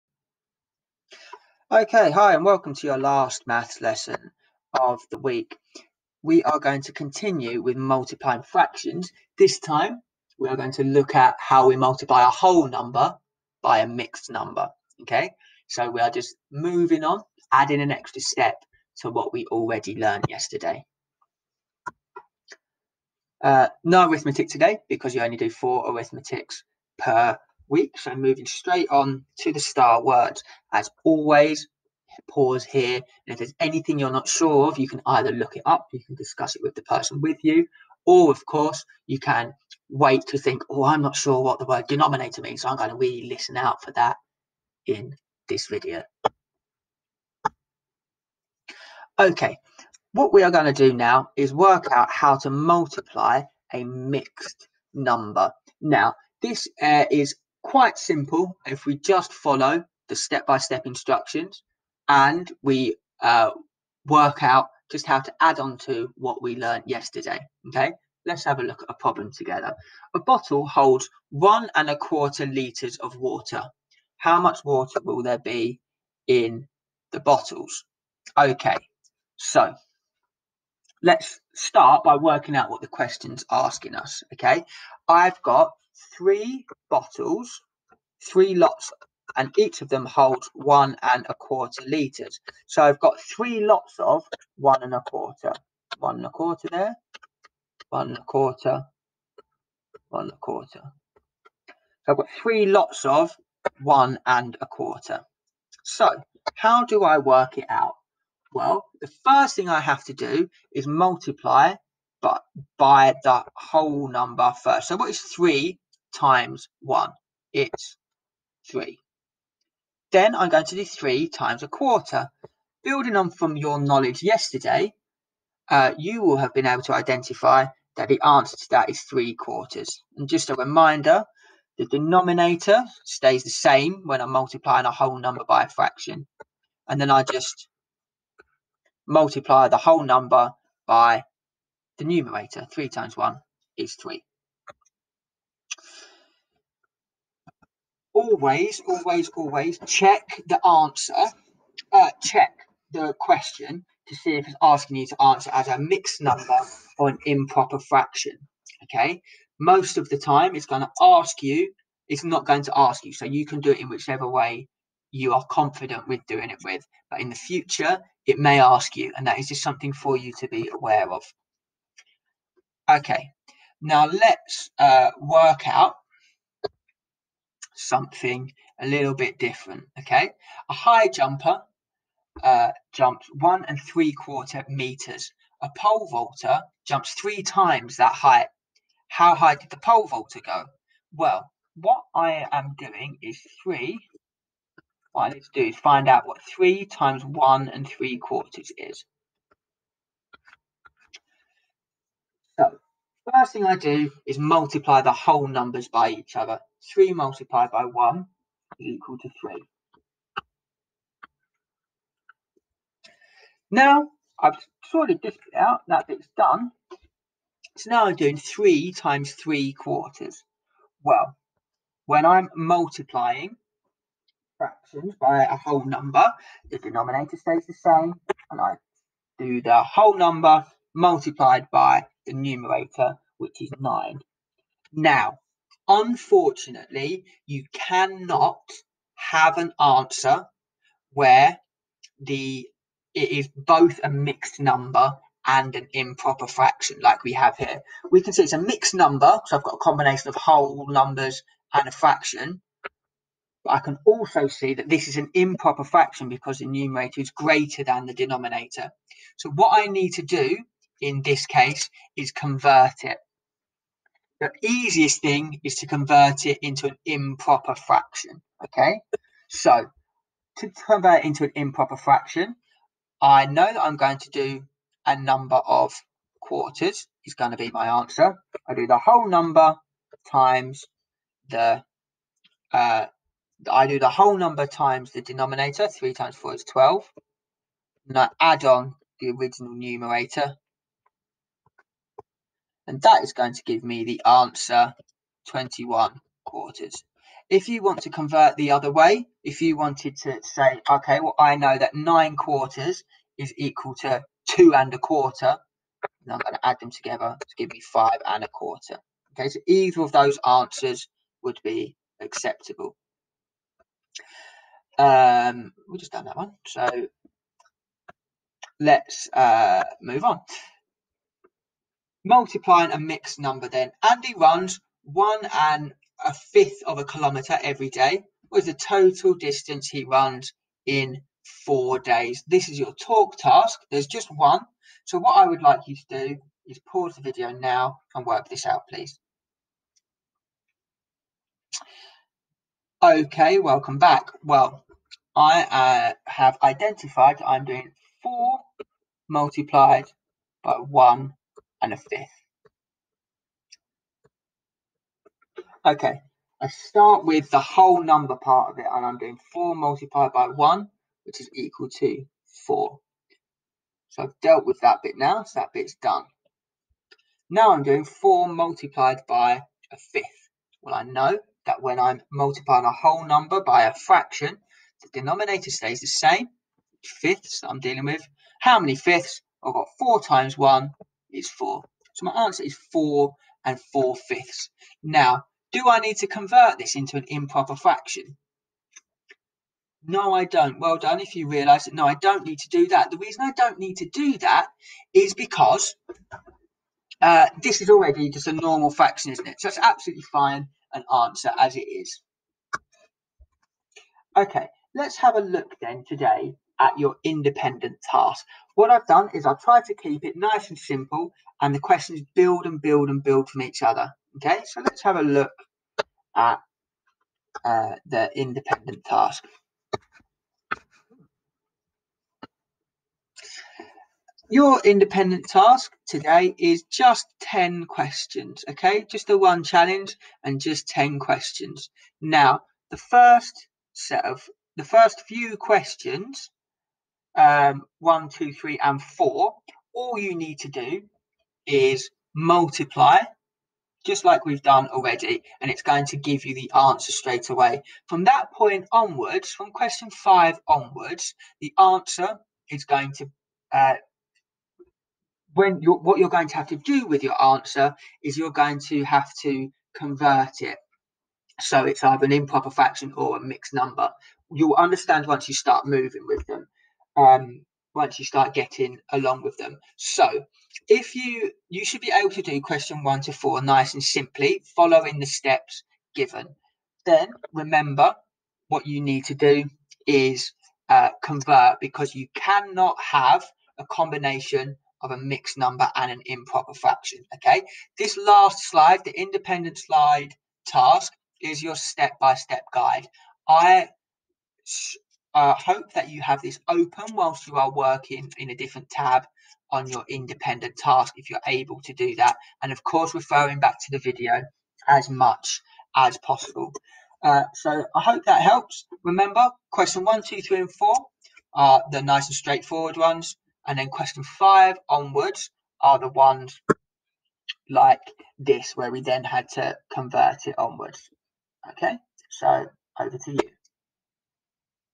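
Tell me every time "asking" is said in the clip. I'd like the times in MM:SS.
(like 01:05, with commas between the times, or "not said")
01:23, 02:34.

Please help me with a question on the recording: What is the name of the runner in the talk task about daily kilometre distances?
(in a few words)
Andy.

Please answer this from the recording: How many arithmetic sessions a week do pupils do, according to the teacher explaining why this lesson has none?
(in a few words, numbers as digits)
4.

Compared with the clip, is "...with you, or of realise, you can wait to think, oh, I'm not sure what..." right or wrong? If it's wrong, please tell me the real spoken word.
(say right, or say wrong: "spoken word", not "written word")
wrong: "course", not "realise".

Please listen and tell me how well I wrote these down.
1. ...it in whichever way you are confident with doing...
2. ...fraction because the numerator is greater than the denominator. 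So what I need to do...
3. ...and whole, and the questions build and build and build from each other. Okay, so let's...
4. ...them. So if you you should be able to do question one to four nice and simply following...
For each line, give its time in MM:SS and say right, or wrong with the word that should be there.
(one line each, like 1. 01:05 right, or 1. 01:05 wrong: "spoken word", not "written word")
1. 02:43 right
2. 04:15 right
3. 06:50 wrong: "simple", not "whole"
4. 07:49 right.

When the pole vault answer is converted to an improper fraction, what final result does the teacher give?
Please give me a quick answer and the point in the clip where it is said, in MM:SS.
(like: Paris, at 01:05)
21 quarters, at 04:55.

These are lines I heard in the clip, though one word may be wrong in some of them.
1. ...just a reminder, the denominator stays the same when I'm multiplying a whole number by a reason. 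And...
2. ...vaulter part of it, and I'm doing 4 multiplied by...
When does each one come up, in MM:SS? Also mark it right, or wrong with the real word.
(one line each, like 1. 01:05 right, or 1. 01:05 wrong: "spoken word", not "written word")
1. 02:10 wrong: "fraction", not "reason"
2. 05:58 wrong: "number", not "vaulter".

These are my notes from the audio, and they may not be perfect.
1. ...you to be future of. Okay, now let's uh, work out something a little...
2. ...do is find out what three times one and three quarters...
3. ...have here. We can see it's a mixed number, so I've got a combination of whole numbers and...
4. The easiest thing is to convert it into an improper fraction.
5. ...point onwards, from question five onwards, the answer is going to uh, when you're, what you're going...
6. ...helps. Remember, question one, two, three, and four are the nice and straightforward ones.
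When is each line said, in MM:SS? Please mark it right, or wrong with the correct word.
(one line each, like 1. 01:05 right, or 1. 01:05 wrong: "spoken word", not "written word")
1. 02:50 wrong: "aware", not "future"
2. 03:15 right
3. 04:07 right
4. 04:24 right
5. 07:28 right
6. 08:28 right.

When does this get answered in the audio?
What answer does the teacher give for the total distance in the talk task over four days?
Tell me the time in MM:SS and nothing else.
06:22.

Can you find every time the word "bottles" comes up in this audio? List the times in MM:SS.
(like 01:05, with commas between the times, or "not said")
01:10, 01:17, 01:26.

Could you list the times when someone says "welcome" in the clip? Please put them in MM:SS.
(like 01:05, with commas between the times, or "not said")
00:02, 05:43.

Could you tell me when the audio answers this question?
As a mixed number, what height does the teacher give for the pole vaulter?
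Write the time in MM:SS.
05:07.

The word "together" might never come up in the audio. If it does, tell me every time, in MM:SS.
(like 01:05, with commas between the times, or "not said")
01:09, 05:06.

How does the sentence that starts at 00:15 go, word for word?
Okay, so we are just moving on, adding an extra step to what we already learned yesterday.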